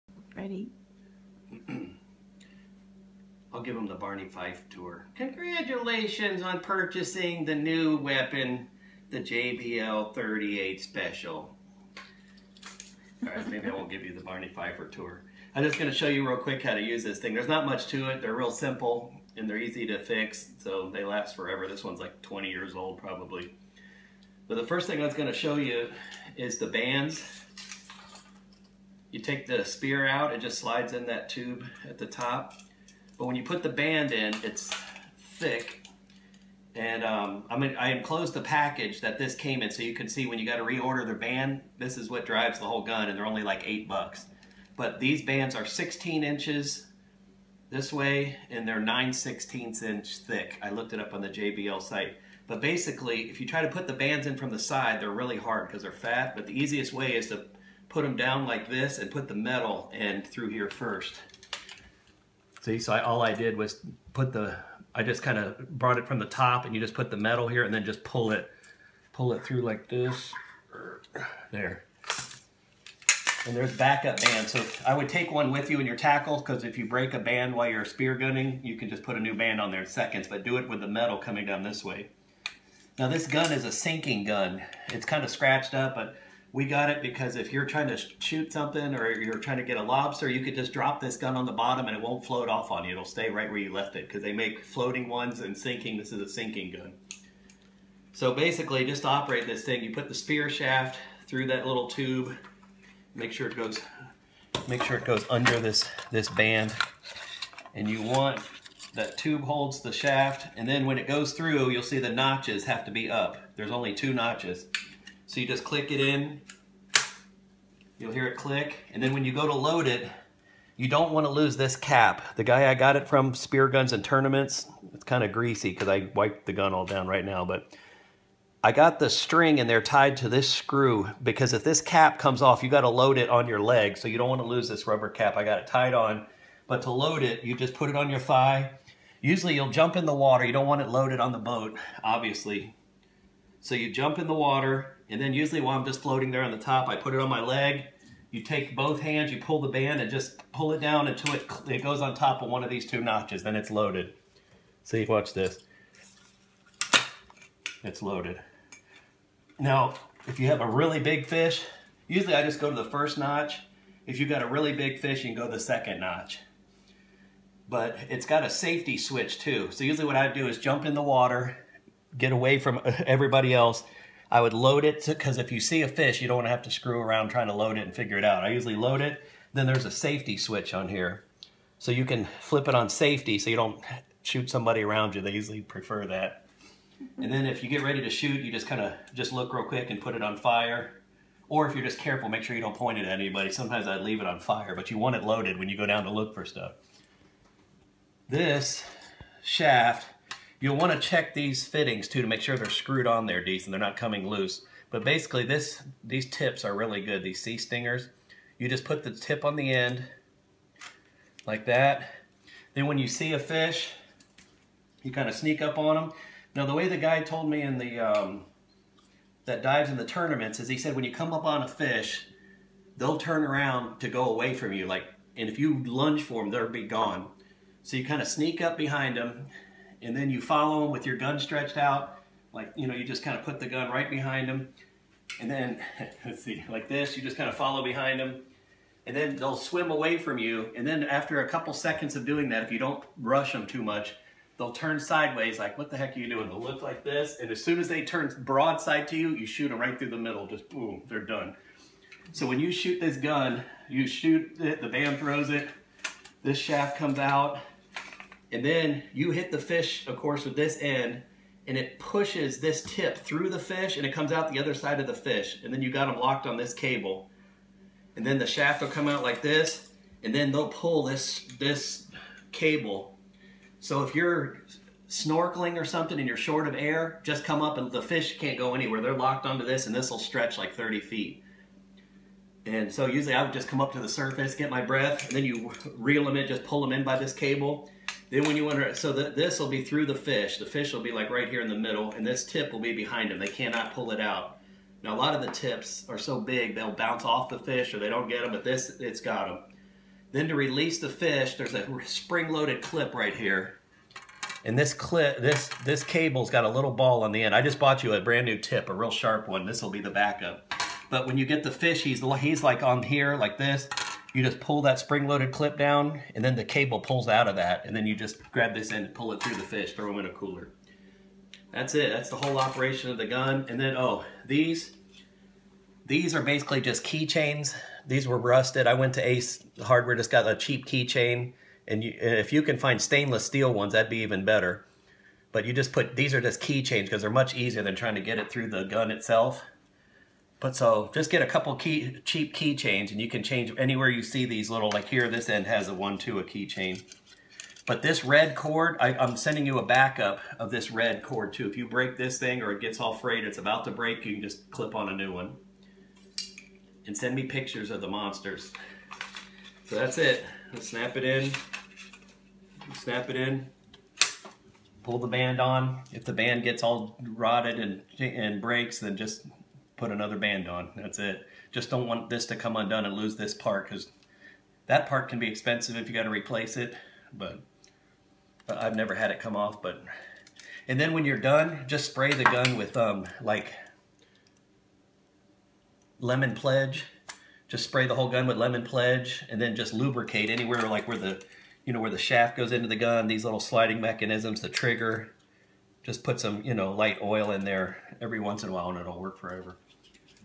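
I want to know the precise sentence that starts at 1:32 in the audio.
It'll stay right where you left it because they make floating ones and sinking.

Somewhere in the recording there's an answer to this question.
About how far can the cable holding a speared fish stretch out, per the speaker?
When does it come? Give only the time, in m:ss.
4:40.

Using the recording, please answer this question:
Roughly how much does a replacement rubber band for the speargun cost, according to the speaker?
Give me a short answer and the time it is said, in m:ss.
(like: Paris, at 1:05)
8 bucks, at 0:43.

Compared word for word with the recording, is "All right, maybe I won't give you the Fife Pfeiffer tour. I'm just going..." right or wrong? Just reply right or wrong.
wrong.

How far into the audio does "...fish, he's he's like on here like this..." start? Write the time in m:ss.
5:11.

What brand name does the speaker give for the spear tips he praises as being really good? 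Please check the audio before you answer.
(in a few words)
Sea Stingers.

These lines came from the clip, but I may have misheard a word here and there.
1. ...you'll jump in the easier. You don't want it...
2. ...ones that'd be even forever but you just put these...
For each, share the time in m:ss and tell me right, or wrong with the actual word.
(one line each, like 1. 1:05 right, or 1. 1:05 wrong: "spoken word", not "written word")
1. 2:19 wrong: "water", not "easier"
2. 5:33 wrong: "better", not "forever".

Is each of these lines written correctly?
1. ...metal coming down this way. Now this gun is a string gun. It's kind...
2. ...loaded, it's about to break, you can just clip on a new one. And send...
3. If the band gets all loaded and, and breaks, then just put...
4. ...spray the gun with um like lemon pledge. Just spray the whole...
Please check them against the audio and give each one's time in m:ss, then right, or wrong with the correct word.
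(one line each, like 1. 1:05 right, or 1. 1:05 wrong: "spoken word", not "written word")
1. 1:20 wrong: "sinking", not "string"
2. 5:53 wrong: "frayed", not "loaded"
3. 6:06 wrong: "rotted", not "loaded"
4. 6:22 right.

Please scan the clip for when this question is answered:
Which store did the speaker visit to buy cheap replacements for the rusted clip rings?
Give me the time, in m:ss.
5:29.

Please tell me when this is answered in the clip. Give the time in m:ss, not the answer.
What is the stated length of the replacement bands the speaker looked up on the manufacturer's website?
0:45.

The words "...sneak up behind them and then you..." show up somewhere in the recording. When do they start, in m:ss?
3:48.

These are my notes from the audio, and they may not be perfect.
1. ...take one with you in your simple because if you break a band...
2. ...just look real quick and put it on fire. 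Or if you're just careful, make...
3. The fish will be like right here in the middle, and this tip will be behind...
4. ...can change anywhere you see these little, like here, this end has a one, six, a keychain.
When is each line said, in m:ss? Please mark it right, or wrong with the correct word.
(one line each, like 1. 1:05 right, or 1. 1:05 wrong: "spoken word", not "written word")
1. 1:15 wrong: "tackle", not "simple"
2. 3:09 right
3. 4:50 right
4. 5:43 wrong: "two", not "six".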